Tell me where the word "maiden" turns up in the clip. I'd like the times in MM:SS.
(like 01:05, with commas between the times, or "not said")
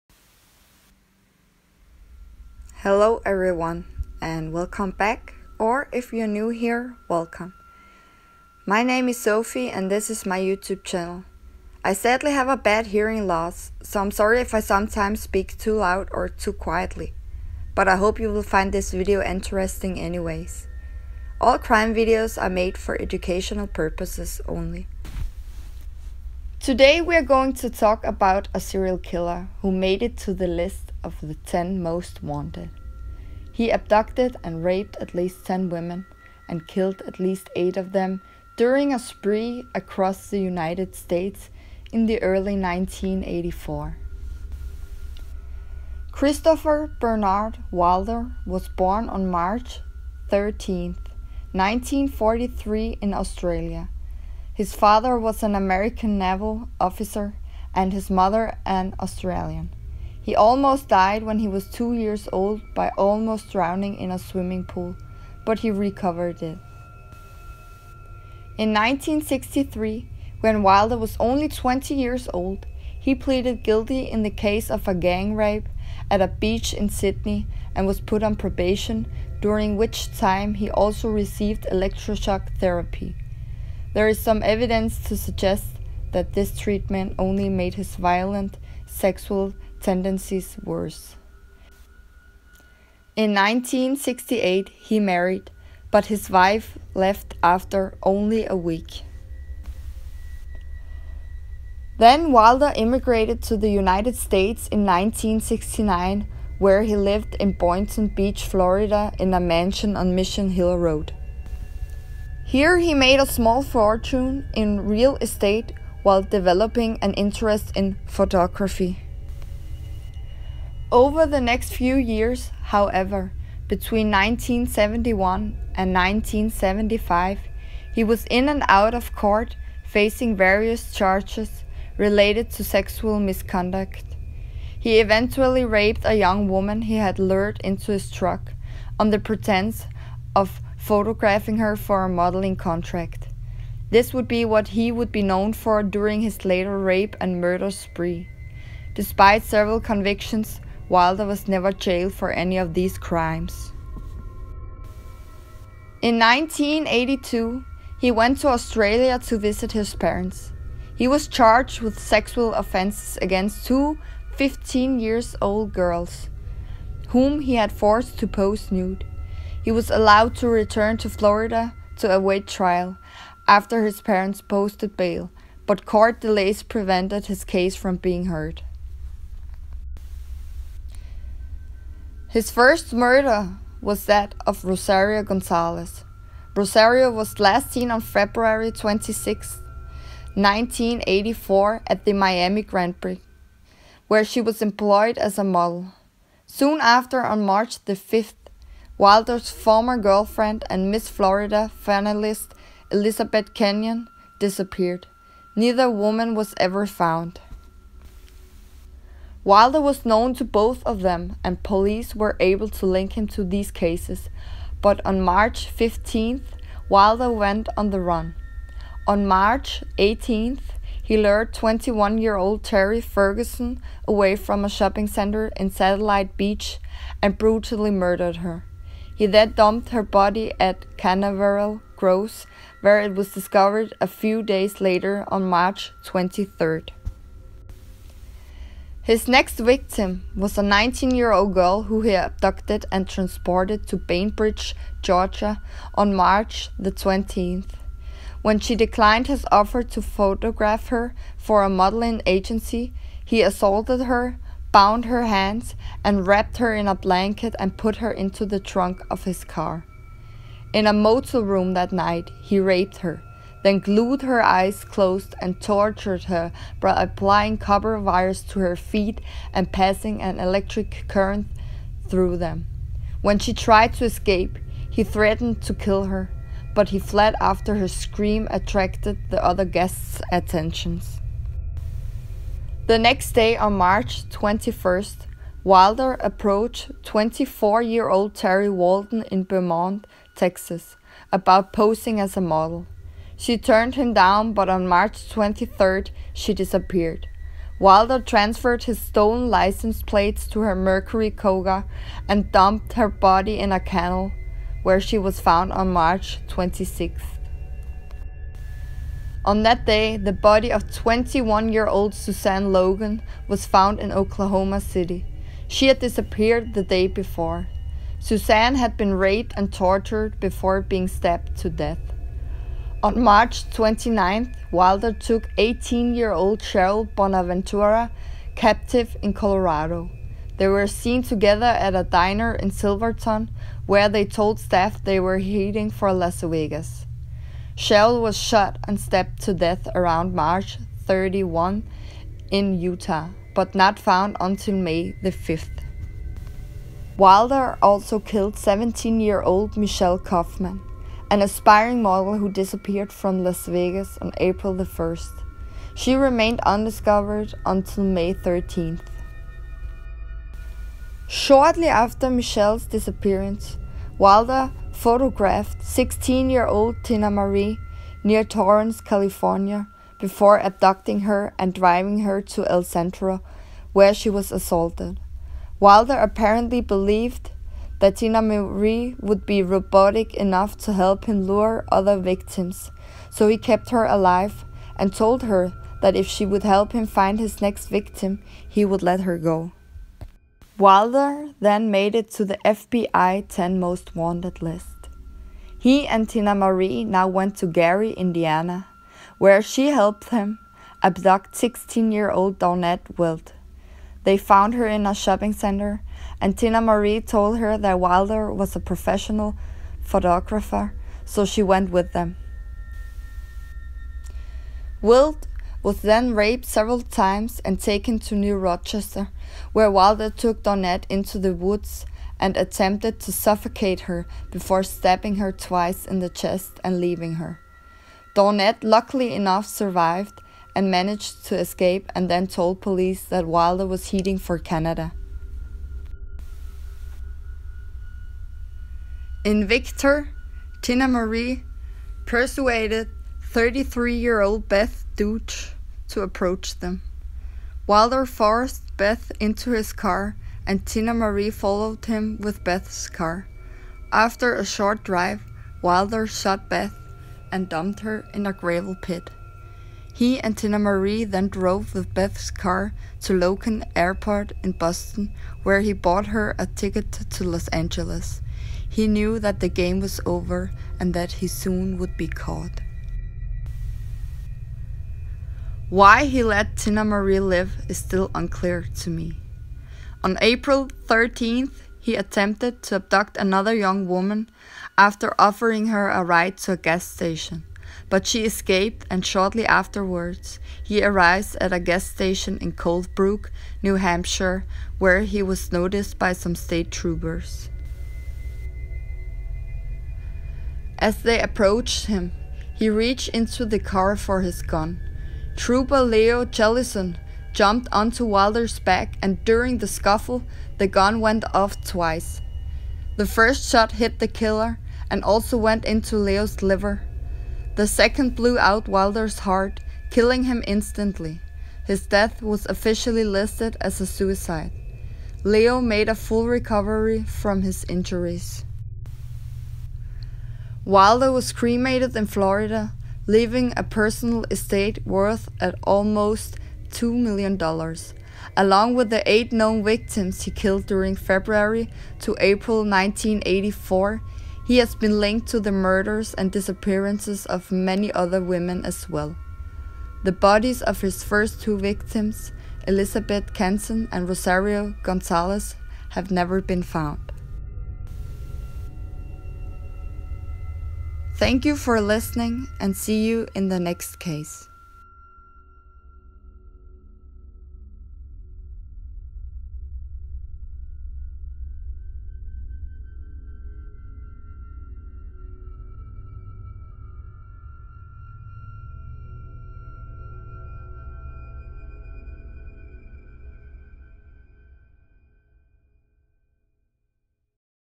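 not said.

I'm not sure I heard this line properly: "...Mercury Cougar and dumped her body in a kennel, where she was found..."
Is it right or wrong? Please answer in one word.
right.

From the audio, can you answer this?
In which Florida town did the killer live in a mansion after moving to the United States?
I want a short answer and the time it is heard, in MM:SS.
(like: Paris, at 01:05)
Boynton Beach, at 01:47.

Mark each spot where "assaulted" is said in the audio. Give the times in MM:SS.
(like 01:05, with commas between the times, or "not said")
04:13, 06:14.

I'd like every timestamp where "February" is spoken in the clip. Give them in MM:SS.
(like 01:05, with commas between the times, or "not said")
03:07, 09:01.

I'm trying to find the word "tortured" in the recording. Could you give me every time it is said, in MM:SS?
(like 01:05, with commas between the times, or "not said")
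04:25, 05:19.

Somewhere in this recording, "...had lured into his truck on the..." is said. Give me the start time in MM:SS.
02:16.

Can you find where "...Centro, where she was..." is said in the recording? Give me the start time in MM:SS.
06:12.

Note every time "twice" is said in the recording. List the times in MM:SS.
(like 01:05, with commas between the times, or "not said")
07:05, 08:31.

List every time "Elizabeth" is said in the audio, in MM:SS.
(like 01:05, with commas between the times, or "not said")
03:22, 09:12.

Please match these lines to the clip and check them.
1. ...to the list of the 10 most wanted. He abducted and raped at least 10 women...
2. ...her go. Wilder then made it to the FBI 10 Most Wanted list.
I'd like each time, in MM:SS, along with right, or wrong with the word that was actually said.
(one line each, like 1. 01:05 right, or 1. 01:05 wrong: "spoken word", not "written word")
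1. 00:30 right
2. 06:29 right.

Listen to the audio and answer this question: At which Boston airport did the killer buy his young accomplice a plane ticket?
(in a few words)
Logan Airport.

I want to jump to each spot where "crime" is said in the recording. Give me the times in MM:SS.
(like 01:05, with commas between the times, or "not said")
00:21, 02:32.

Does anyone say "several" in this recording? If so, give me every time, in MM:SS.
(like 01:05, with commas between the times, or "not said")
02:29, 06:56.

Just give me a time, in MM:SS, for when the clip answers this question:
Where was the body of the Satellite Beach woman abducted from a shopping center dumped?
03:50.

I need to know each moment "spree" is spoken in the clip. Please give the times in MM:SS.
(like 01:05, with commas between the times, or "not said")
00:38, 02:27.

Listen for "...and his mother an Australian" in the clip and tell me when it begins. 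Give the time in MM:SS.
00:57.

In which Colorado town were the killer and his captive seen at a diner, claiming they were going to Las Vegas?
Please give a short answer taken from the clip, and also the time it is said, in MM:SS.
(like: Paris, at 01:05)
Silverton, at 05:32.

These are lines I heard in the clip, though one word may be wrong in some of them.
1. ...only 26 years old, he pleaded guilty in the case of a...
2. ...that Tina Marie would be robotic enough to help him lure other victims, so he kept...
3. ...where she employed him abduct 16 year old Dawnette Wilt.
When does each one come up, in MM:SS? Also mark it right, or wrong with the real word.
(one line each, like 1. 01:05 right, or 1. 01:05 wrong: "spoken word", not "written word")
1. 01:11 wrong: "20", not "26"
2. 06:18 right
3. 06:39 wrong: "helped", not "employed".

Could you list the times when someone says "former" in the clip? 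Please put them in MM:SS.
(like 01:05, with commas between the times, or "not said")
03:19.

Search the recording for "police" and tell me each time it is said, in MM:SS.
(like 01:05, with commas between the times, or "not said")
03:31, 07:12.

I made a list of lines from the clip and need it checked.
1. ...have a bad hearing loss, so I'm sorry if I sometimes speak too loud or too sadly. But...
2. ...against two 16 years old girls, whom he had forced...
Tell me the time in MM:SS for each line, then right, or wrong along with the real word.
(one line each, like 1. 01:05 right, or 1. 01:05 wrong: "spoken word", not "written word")
1. 00:12 wrong: "quietly", not "sadly"
2. 02:43 wrong: "15", not "16".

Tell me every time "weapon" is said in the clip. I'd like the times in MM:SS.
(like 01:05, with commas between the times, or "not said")
not said.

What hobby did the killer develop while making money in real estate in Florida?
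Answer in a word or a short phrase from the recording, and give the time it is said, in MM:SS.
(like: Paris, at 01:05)
Photography, at 01:58.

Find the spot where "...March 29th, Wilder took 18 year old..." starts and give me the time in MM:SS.
05:23.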